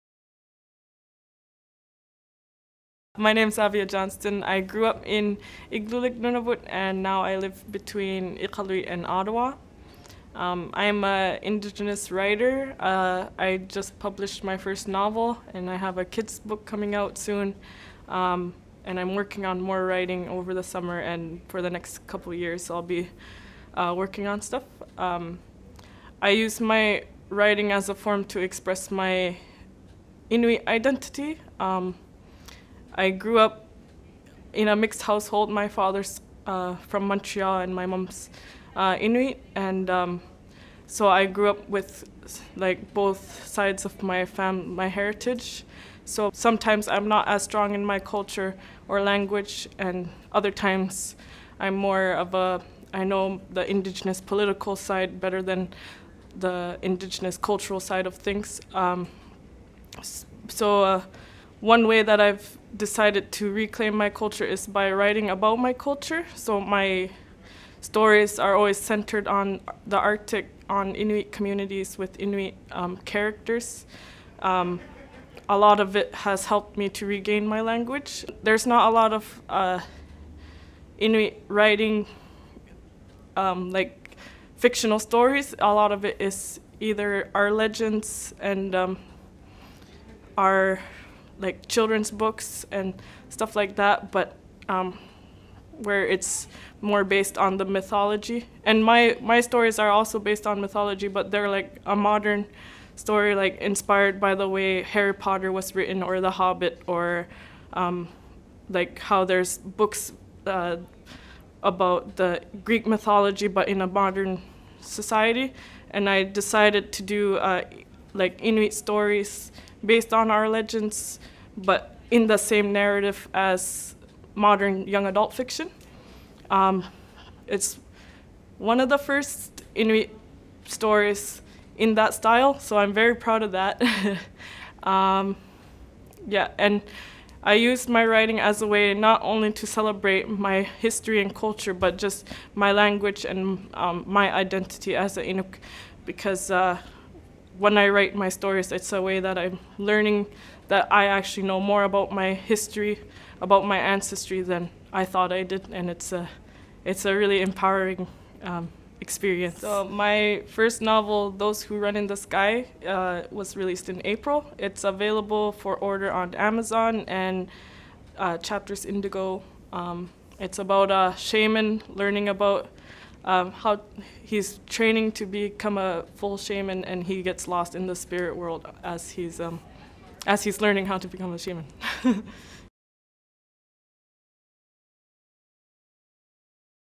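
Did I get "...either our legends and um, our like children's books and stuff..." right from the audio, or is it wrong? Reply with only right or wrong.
right.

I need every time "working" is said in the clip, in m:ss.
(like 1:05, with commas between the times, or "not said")
0:19, 0:23.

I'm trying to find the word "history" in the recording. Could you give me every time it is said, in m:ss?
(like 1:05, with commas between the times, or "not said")
2:20, 2:32.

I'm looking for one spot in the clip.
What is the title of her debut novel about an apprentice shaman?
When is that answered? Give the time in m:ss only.
2:41.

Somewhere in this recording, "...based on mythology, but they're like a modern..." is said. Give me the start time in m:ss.
1:40.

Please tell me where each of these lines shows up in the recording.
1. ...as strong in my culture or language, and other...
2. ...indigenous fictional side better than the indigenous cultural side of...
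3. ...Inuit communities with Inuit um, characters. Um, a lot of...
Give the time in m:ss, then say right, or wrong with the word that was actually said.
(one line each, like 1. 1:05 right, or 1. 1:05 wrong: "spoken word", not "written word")
1. 0:47 right
2. 0:53 wrong: "political", not "fictional"
3. 1:10 right.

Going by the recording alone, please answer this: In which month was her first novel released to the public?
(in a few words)
April.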